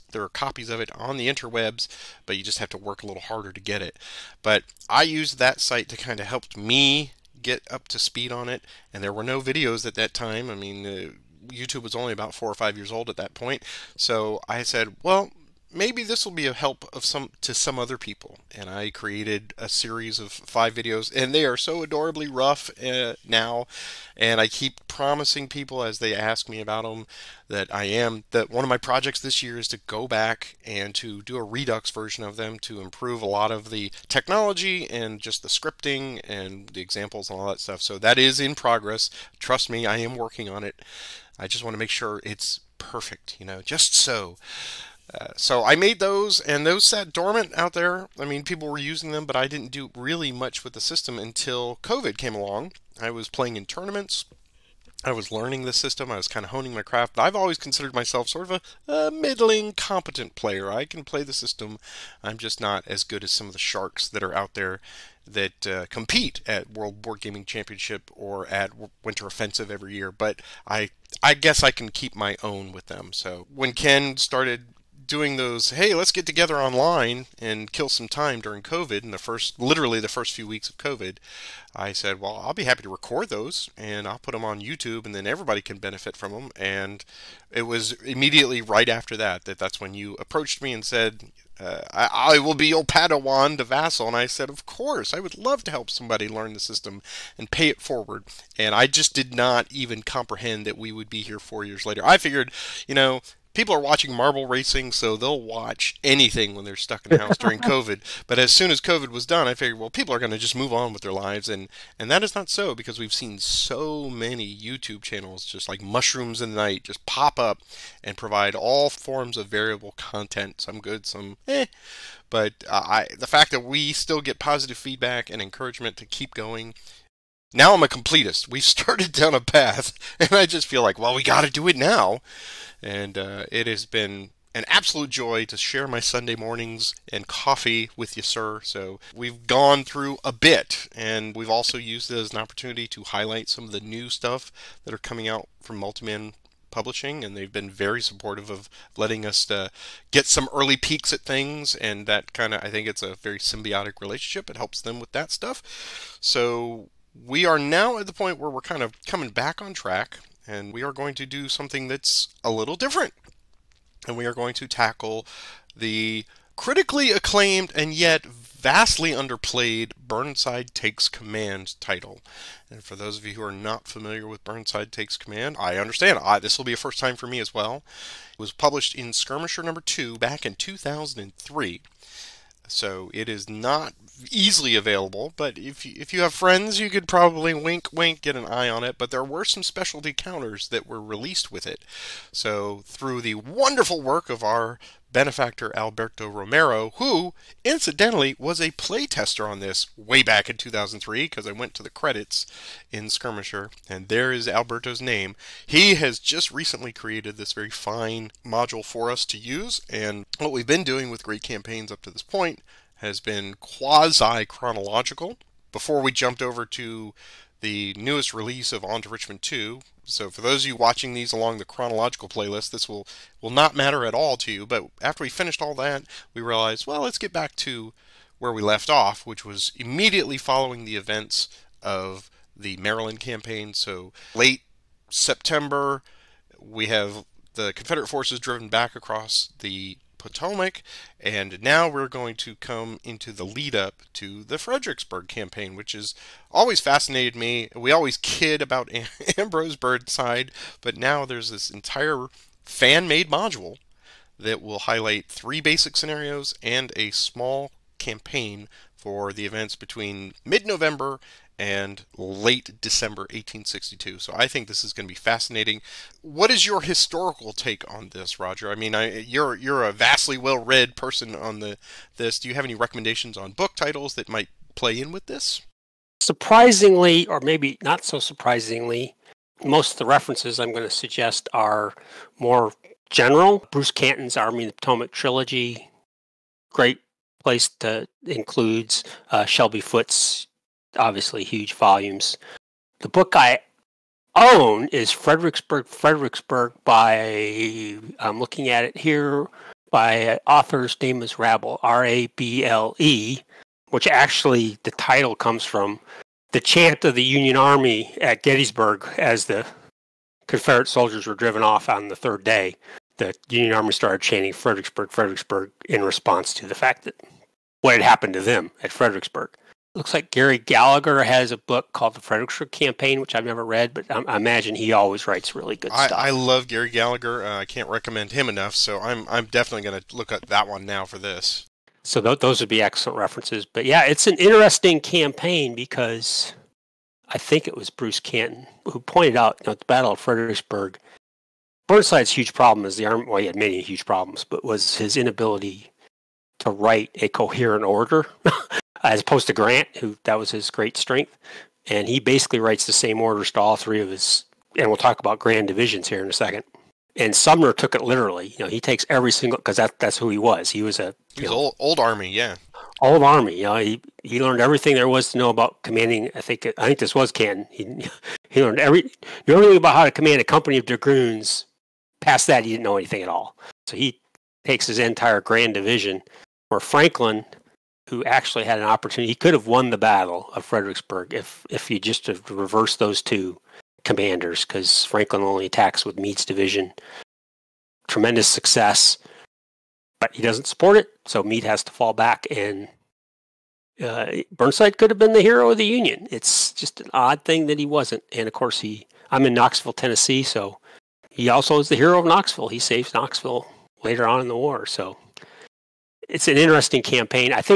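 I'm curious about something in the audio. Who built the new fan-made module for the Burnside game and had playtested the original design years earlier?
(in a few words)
Alberto Romero.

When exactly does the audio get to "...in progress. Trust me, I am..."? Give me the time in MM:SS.
00:38.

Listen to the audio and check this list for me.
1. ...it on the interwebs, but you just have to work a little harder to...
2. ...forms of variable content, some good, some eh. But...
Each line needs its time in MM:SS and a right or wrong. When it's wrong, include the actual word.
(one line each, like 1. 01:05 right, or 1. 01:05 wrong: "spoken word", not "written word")
1. 00:00 right
2. 01:58 right.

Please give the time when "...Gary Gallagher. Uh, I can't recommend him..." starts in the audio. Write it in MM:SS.
05:26.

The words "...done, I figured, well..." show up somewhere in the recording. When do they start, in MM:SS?
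01:49.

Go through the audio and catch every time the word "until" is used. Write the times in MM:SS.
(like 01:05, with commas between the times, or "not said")
00:51.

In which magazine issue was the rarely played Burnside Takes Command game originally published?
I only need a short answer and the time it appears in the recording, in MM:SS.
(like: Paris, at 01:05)
Skirmisher number 2, at 02:59.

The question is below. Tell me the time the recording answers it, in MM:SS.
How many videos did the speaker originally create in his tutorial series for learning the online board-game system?
00:20.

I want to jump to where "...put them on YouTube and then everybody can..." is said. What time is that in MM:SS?
01:24.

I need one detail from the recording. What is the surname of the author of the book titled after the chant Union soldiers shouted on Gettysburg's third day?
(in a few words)
Rable.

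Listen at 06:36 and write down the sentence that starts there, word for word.
It's just an odd thing that he wasn't.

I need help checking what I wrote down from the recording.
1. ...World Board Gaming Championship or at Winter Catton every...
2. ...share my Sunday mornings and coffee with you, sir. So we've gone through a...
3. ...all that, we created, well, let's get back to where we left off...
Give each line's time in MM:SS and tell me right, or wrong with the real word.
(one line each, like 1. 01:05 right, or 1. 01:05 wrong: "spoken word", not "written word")
1. 01:06 wrong: "Offensive", not "Catton"
2. 02:15 right
3. 03:45 wrong: "realized", not "created".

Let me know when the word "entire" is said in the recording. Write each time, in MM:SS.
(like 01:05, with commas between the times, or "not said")
04:11, 06:14.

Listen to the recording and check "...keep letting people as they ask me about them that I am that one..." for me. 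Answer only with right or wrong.
wrong.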